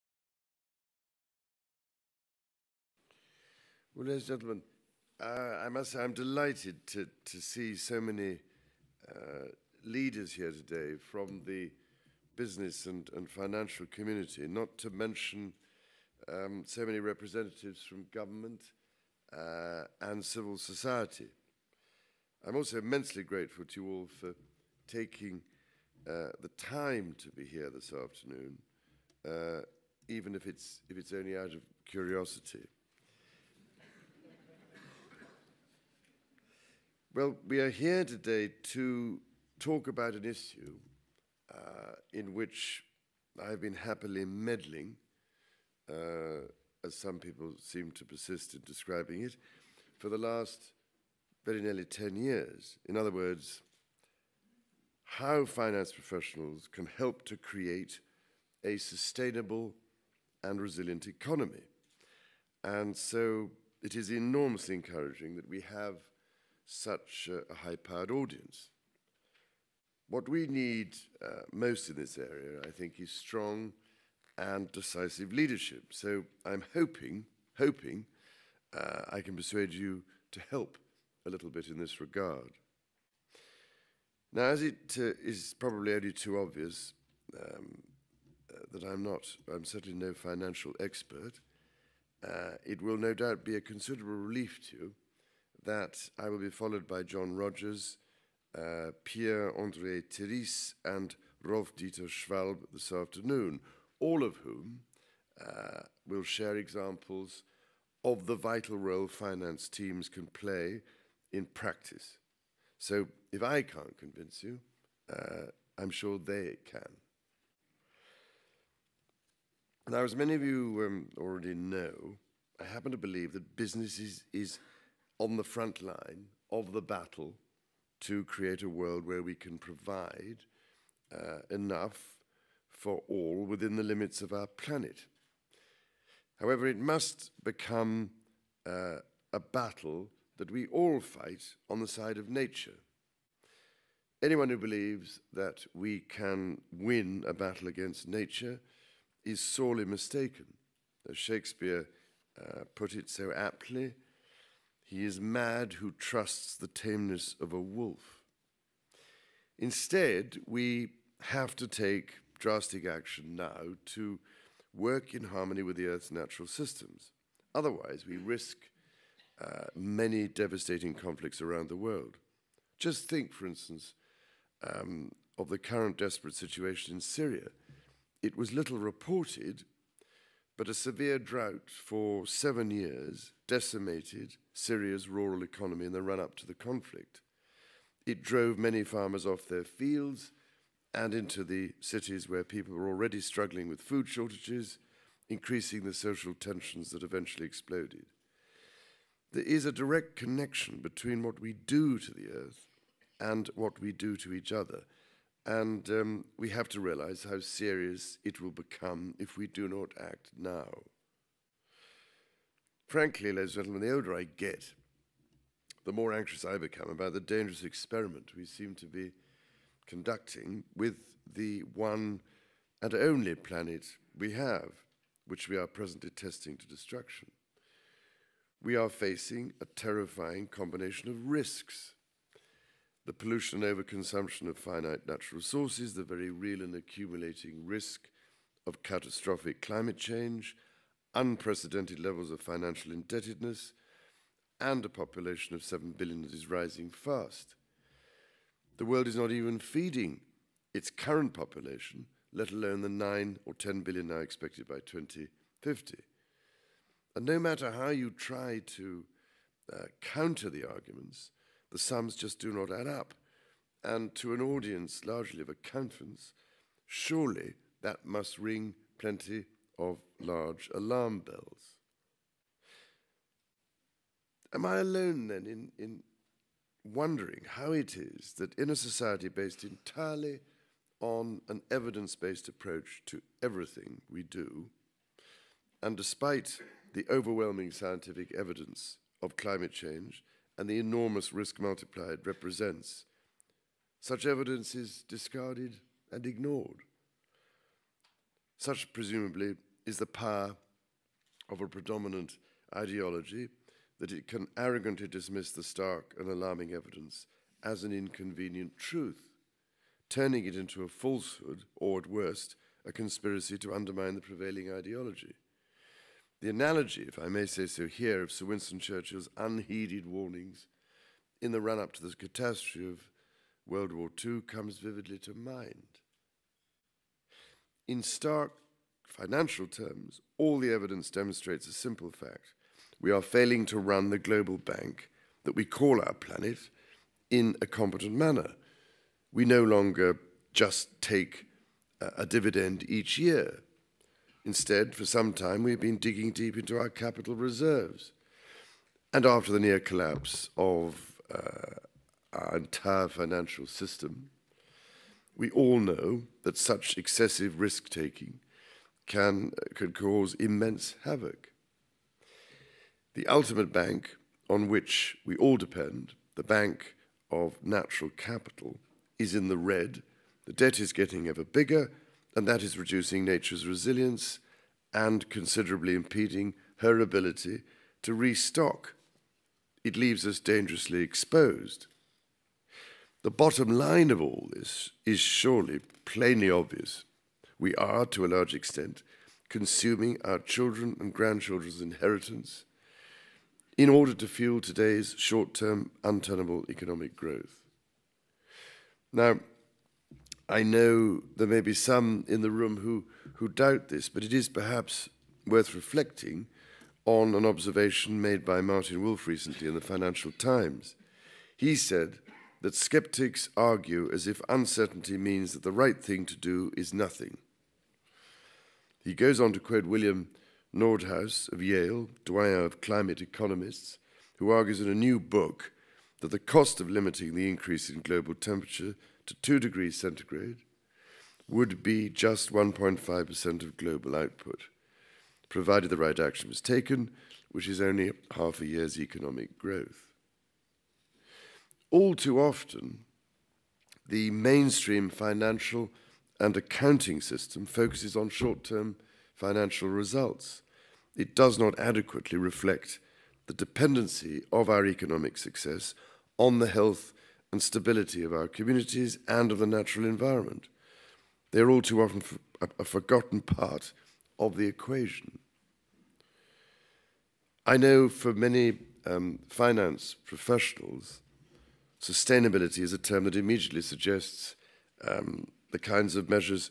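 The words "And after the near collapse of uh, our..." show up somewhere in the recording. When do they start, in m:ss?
5:49.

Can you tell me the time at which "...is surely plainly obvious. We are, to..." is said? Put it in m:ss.
6:25.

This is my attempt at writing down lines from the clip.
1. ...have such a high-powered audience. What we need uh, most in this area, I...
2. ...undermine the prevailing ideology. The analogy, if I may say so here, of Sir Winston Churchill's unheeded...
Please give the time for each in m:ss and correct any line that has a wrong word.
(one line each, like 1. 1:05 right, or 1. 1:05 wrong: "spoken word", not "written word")
1. 1:05 right
2. 5:13 right.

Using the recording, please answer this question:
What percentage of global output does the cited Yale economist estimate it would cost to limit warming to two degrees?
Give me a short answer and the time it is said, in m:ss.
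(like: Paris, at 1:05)
1.5%, at 7:12.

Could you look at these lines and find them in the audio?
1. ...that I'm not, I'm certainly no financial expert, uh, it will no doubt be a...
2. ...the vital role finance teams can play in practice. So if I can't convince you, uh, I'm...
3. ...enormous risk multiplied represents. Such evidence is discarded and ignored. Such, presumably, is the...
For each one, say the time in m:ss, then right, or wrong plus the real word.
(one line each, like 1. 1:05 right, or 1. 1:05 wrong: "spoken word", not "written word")
1. 1:28 right
2. 1:48 right
3. 4:50 right.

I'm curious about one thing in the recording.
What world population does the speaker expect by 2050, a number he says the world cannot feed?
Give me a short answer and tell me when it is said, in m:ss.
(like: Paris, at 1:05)
9 or 10 billion, at 4:12.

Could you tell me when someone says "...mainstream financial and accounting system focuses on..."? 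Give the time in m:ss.
7:24.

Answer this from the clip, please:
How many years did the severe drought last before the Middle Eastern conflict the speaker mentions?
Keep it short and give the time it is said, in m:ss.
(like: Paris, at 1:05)
7, at 3:02.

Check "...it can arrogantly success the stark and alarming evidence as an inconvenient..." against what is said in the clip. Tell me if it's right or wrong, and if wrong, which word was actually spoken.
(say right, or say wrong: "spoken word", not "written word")
wrong: "dismiss", not "success".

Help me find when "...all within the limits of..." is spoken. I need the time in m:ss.
2:13.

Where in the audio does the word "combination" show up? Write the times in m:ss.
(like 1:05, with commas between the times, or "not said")
3:50.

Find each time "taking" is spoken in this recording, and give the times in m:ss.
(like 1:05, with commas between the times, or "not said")
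0:24, 5:57.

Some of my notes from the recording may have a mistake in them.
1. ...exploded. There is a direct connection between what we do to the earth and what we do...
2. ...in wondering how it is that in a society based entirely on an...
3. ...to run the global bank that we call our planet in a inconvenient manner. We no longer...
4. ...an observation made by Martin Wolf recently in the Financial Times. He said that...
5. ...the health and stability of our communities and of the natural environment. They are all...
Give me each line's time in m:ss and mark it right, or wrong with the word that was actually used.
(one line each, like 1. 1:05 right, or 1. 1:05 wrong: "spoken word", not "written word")
1. 3:17 right
2. 4:35 right
3. 5:33 wrong: "competent", not "inconvenient"
4. 6:47 right
5. 7:36 right.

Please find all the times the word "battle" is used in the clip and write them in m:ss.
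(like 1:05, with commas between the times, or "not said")
2:06, 2:19, 2:27.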